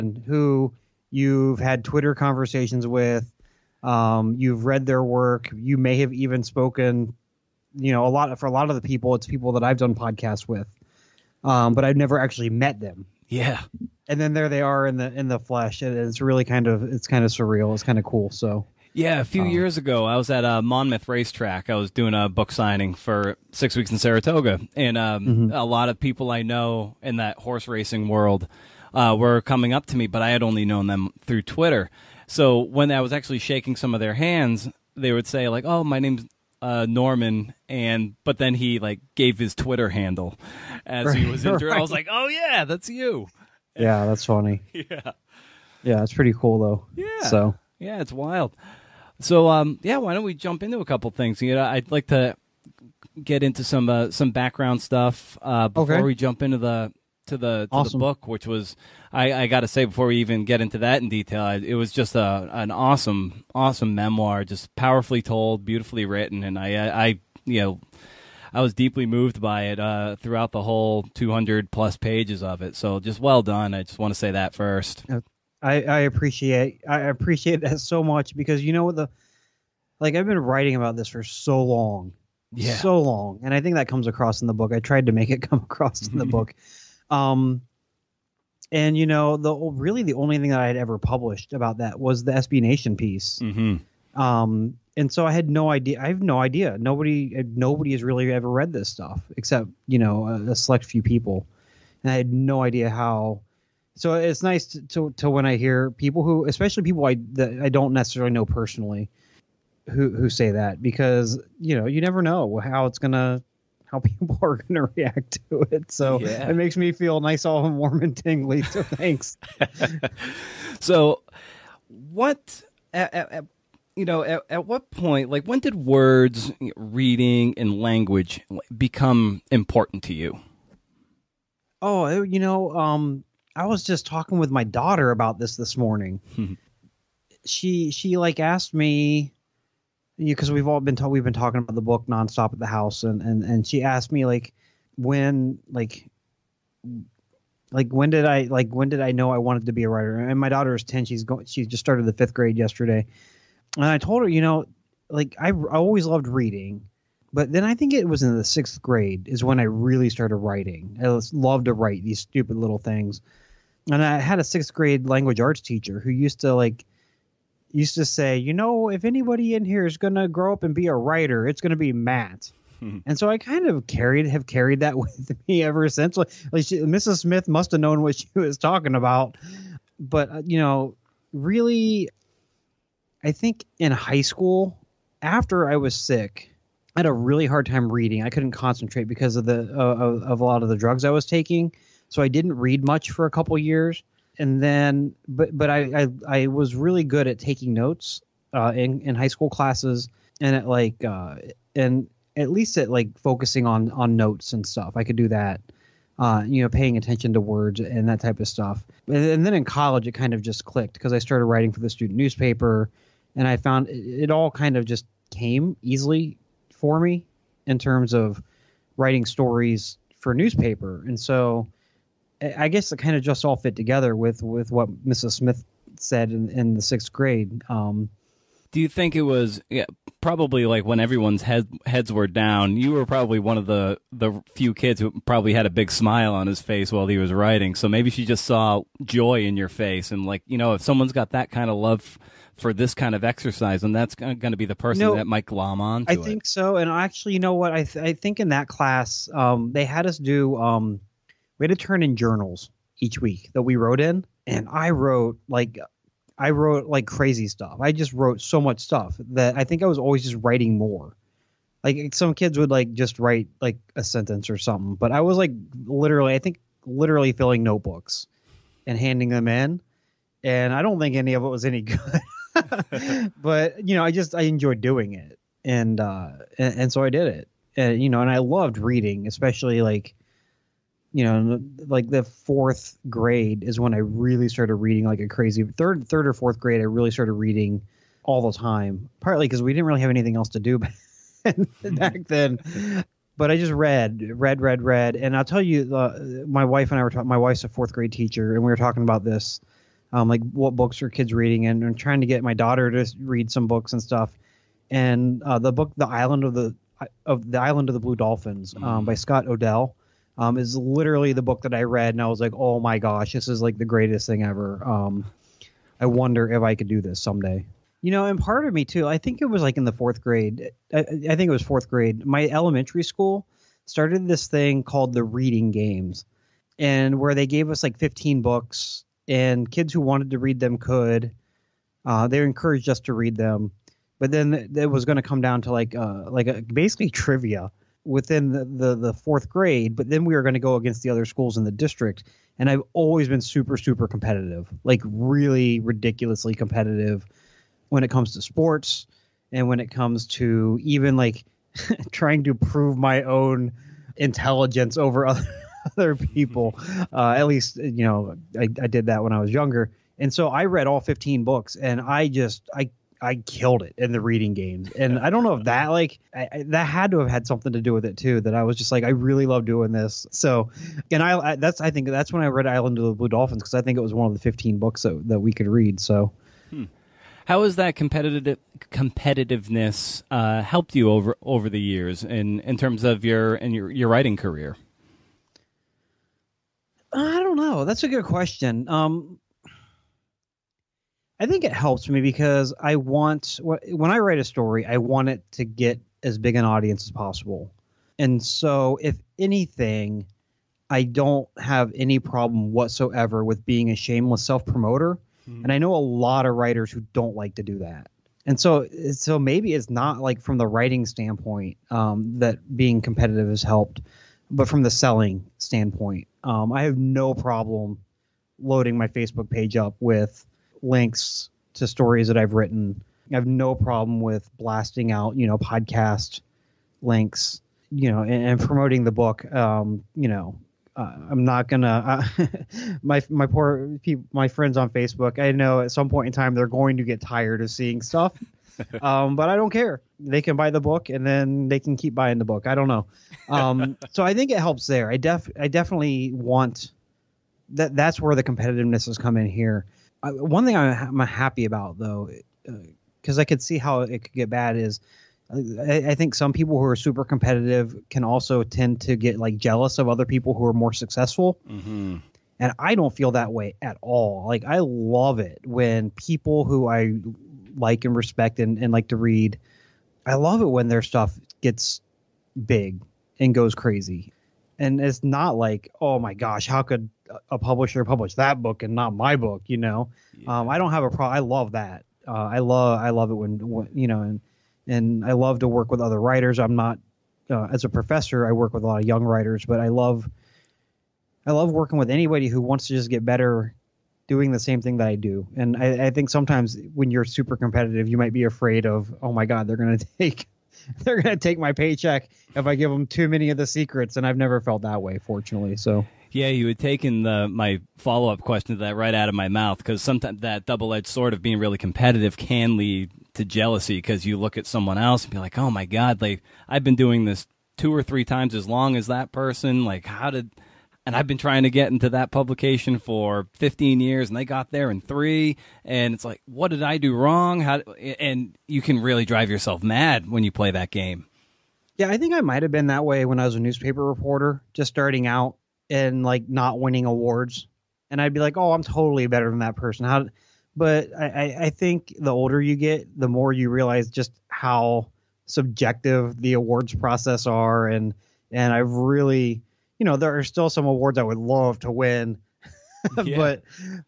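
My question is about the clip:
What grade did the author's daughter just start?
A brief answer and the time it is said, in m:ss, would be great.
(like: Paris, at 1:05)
fifth grade, at 2:32.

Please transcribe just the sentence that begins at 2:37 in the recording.
But then I think it was in the sixth grade is when I really started writing.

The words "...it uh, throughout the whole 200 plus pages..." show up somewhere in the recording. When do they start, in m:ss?
1:09.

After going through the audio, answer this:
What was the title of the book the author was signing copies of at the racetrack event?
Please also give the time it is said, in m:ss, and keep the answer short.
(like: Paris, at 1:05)
Six Weeks in Saratoga, at 0:23.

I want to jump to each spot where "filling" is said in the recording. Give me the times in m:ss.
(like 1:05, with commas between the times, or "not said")
4:27.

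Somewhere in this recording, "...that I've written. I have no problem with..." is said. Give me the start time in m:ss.
7:02.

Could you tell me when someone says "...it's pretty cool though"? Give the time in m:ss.
0:46.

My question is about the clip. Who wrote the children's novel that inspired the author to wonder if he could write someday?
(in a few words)
Scott O'Dell.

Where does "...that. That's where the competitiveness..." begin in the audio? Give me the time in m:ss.
7:27.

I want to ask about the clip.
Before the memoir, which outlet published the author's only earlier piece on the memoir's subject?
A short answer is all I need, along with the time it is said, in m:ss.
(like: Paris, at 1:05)
SB Nation, at 1:32.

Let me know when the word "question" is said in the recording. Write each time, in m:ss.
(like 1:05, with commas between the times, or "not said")
6:28, 8:28.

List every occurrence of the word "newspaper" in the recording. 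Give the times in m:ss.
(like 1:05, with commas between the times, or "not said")
3:32, 3:40, 8:53.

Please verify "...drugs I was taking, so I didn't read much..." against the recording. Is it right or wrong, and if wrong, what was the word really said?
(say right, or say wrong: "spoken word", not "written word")
right.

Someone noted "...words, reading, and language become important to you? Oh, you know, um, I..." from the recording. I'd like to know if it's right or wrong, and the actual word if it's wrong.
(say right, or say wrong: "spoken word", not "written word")
right.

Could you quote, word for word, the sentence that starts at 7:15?
I know at some point in time they're going to get tired of seeing stuff.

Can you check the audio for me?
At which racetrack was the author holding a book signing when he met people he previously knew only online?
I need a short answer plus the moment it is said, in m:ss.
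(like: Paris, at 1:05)
Monmouth Racetrack, at 0:20.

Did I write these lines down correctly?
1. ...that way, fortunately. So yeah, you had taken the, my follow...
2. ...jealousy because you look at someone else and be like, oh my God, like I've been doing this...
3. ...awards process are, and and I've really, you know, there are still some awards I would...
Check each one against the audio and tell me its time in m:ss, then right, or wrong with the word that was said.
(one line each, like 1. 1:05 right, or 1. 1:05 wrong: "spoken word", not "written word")
1. 8:24 right
2. 8:33 right
3. 9:06 right.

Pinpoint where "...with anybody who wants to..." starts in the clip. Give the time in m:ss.
8:11.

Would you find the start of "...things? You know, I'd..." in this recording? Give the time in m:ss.
0:51.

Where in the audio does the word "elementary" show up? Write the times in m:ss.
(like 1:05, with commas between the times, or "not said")
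5:22.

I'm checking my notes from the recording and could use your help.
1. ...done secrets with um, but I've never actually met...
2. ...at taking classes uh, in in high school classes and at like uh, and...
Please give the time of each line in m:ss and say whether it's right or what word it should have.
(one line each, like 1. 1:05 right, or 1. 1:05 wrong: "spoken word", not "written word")
1. 0:09 wrong: "podcasts", not "secrets"
2. 3:17 wrong: "notes", not "classes".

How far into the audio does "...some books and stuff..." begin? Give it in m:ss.
5:03.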